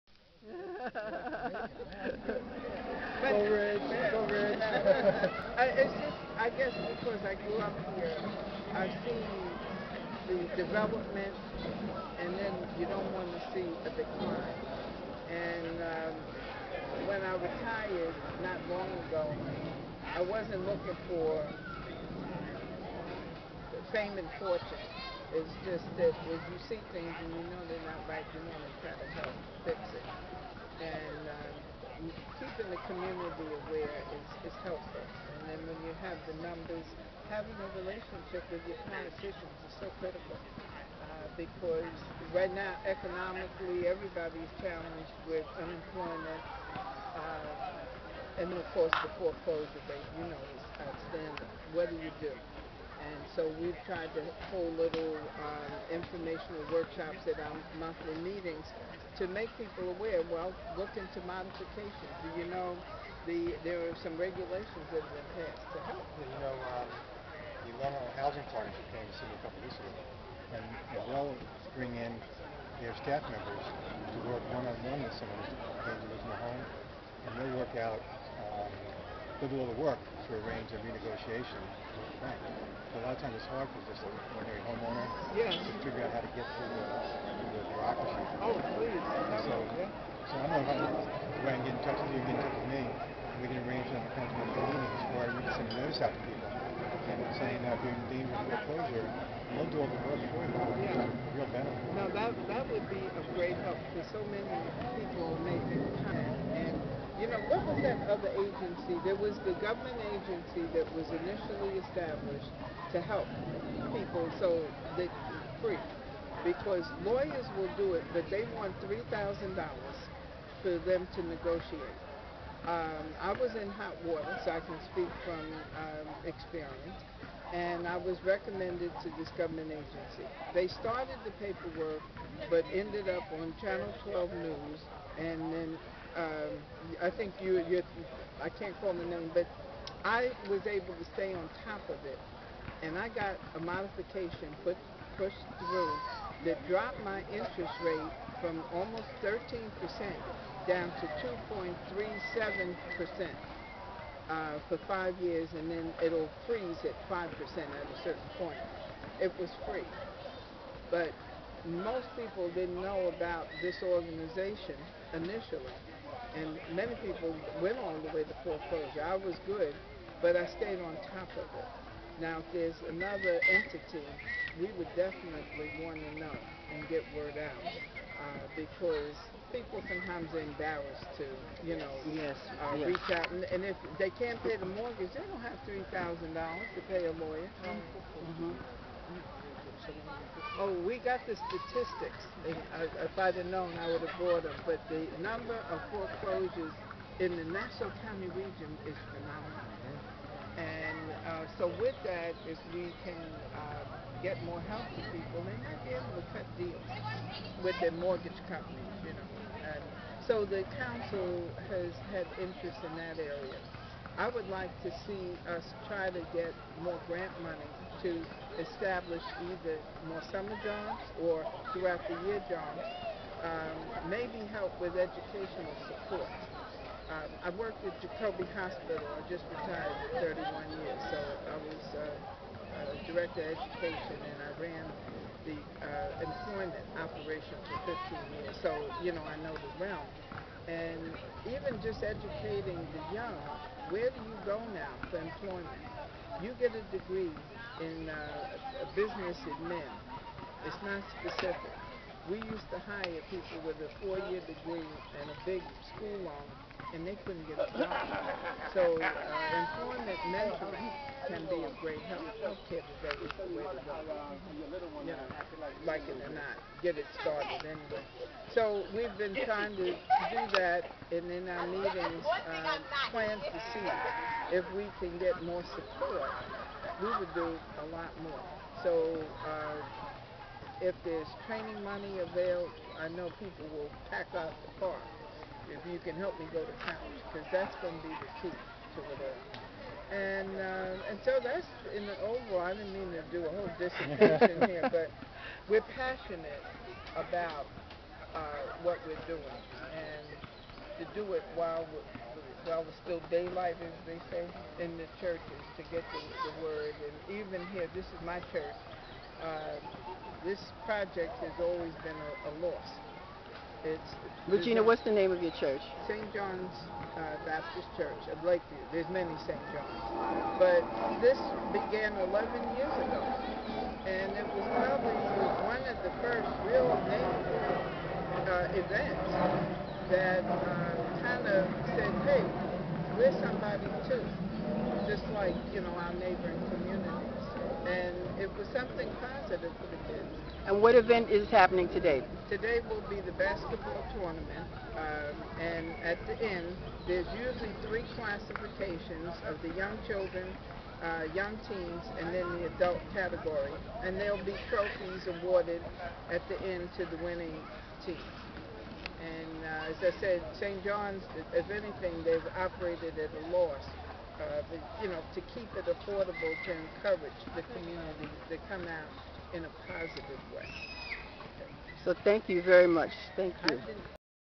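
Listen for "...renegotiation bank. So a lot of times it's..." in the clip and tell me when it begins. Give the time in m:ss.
1:20.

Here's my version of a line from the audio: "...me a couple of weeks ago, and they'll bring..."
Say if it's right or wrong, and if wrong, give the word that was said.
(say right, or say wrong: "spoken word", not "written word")
right.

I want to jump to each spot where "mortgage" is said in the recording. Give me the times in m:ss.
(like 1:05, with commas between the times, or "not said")
3:04, 3:27.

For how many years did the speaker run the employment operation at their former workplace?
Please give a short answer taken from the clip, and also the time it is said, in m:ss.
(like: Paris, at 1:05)
15, at 3:57.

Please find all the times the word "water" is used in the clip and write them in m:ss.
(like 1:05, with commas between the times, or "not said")
2:04.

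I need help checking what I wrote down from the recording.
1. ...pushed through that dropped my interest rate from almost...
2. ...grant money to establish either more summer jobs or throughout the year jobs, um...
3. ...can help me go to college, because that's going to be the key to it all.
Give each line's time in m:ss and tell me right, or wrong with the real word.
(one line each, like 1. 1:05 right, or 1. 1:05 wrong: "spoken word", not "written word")
1. 2:25 right
2. 3:37 right
3. 4:46 right.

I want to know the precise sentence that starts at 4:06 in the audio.
You get a degree in uh, business admin.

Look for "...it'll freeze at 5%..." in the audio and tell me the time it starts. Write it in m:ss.
2:36.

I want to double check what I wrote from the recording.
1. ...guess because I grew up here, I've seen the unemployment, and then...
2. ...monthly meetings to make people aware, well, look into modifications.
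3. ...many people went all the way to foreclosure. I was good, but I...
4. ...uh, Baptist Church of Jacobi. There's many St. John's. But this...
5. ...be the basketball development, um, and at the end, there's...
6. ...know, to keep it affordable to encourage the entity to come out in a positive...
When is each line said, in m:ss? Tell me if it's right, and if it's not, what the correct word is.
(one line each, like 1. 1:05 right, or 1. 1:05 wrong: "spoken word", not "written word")
1. 0:06 wrong: "development", not "unemployment"
2. 0:57 right
3. 2:46 right
4. 5:17 wrong: "Lakeview", not "Jacobi"
5. 5:43 wrong: "tournament", not "development"
6. 6:05 wrong: "community", not "entity".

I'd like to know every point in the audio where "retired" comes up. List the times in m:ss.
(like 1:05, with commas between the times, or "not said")
0:17, 3:49.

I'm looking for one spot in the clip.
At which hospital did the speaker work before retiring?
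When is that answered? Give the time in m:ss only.
3:48.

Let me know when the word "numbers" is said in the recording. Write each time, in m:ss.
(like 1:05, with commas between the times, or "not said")
0:36, 3:15.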